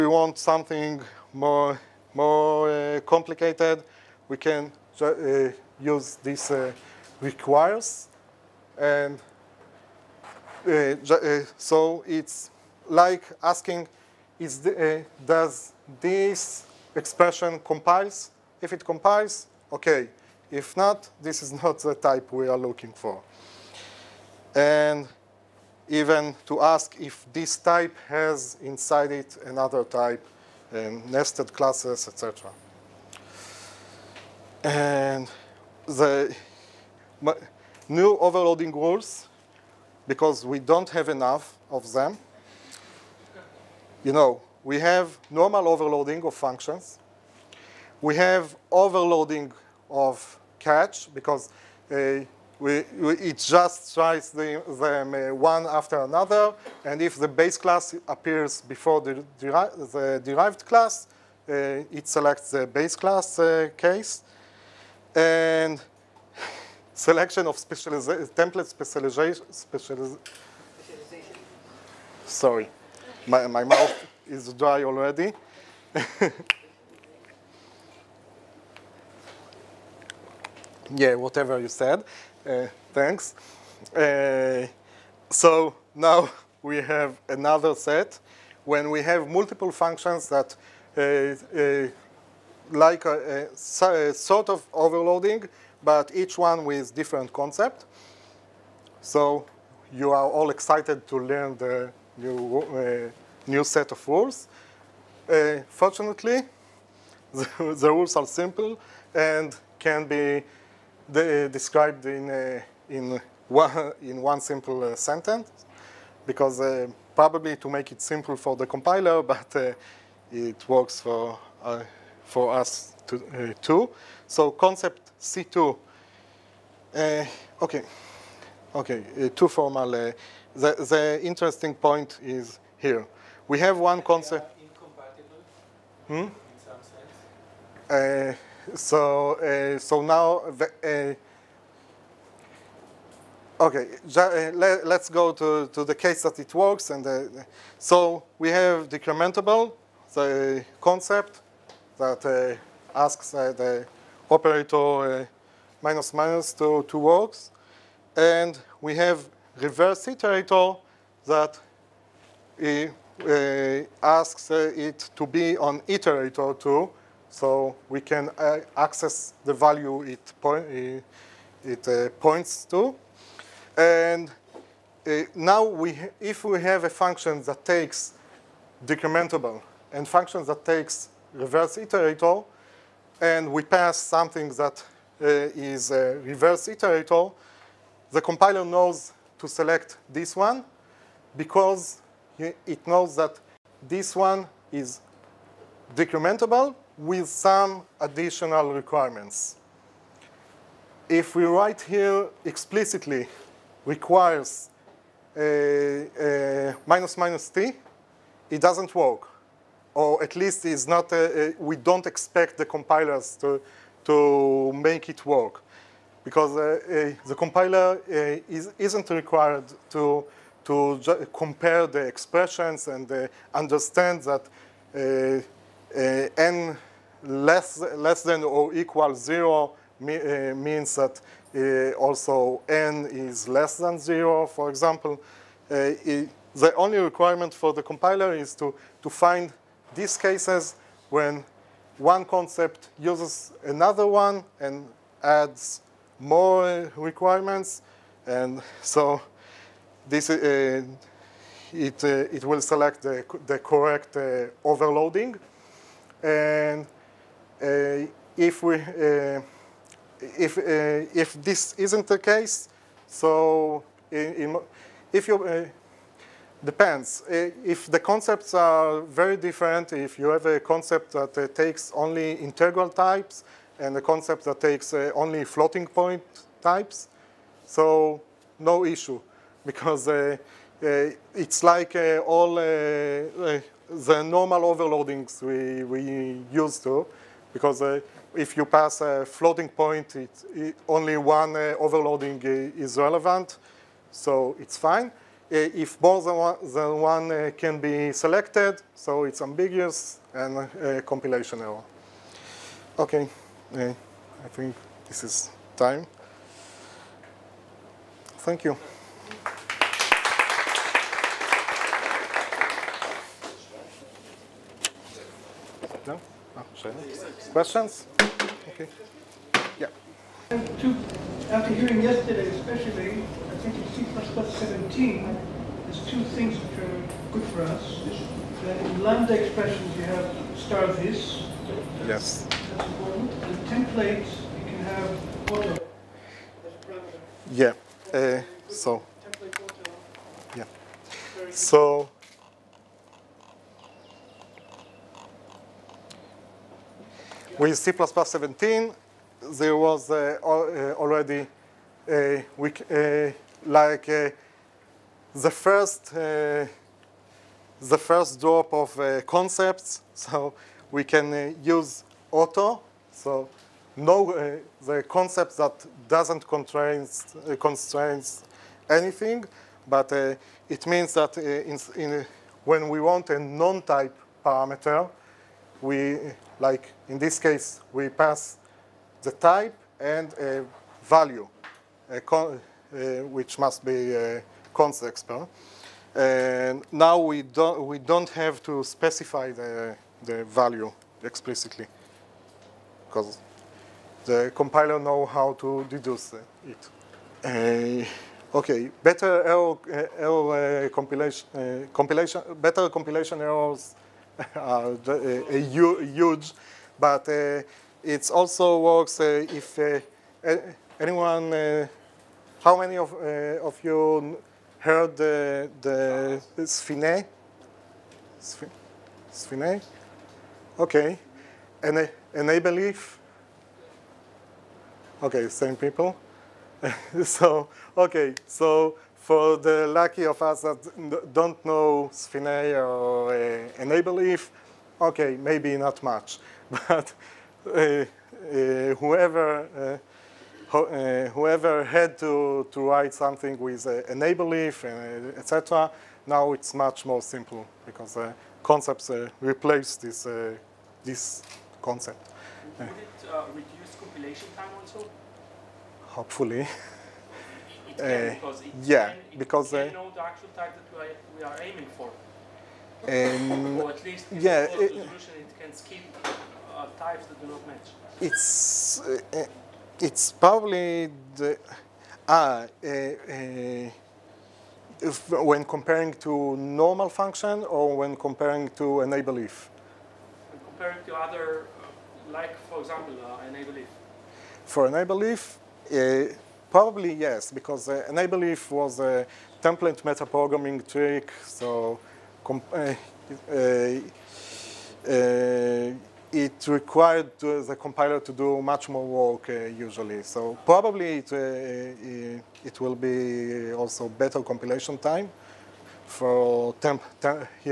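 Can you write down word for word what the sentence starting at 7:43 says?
Um, or at least yeah, it, resolution, it can skip uh, types that do not match.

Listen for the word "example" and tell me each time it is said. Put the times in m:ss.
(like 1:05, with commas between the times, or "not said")
3:54, 8:02.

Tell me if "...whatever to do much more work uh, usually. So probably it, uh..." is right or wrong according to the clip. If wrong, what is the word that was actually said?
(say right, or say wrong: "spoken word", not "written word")
wrong: "compiler", not "whatever".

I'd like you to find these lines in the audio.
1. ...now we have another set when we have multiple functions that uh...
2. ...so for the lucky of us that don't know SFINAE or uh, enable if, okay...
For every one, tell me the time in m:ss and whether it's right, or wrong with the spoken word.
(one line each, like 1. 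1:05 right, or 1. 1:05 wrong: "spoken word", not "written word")
1. 1:25 right
2. 7:08 right.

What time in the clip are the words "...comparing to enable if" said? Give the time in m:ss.
7:58.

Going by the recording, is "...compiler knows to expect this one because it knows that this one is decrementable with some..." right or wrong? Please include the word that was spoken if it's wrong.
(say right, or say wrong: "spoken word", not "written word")
wrong: "select", not "expect".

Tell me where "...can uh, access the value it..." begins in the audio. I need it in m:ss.
2:48.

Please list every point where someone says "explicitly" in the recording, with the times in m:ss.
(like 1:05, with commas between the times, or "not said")
3:22, 6:31.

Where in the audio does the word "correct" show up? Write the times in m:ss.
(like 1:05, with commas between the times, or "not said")
4:13.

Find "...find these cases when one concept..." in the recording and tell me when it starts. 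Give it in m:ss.
3:59.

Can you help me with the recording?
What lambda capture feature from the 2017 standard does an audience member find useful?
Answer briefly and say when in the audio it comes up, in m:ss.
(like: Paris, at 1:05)
star this, at 5:30.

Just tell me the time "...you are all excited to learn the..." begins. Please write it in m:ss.
1:39.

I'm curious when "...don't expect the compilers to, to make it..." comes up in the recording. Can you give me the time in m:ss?
3:31.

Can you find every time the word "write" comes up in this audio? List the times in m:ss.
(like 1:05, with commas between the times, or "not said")
3:21, 7:22.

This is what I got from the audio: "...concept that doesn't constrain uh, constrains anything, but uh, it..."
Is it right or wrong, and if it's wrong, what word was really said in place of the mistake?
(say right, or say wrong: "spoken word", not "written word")
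right.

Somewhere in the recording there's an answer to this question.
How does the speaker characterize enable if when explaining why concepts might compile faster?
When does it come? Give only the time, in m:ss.
8:09.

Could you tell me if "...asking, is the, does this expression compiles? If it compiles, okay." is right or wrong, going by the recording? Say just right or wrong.
right.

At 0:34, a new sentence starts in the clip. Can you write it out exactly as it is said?
And the new overloading rules, because we don't have enough of them, you know, we have normal overloading of functions.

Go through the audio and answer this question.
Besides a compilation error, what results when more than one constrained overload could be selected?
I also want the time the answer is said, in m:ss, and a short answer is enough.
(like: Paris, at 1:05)
Ambiguous, at 4:59.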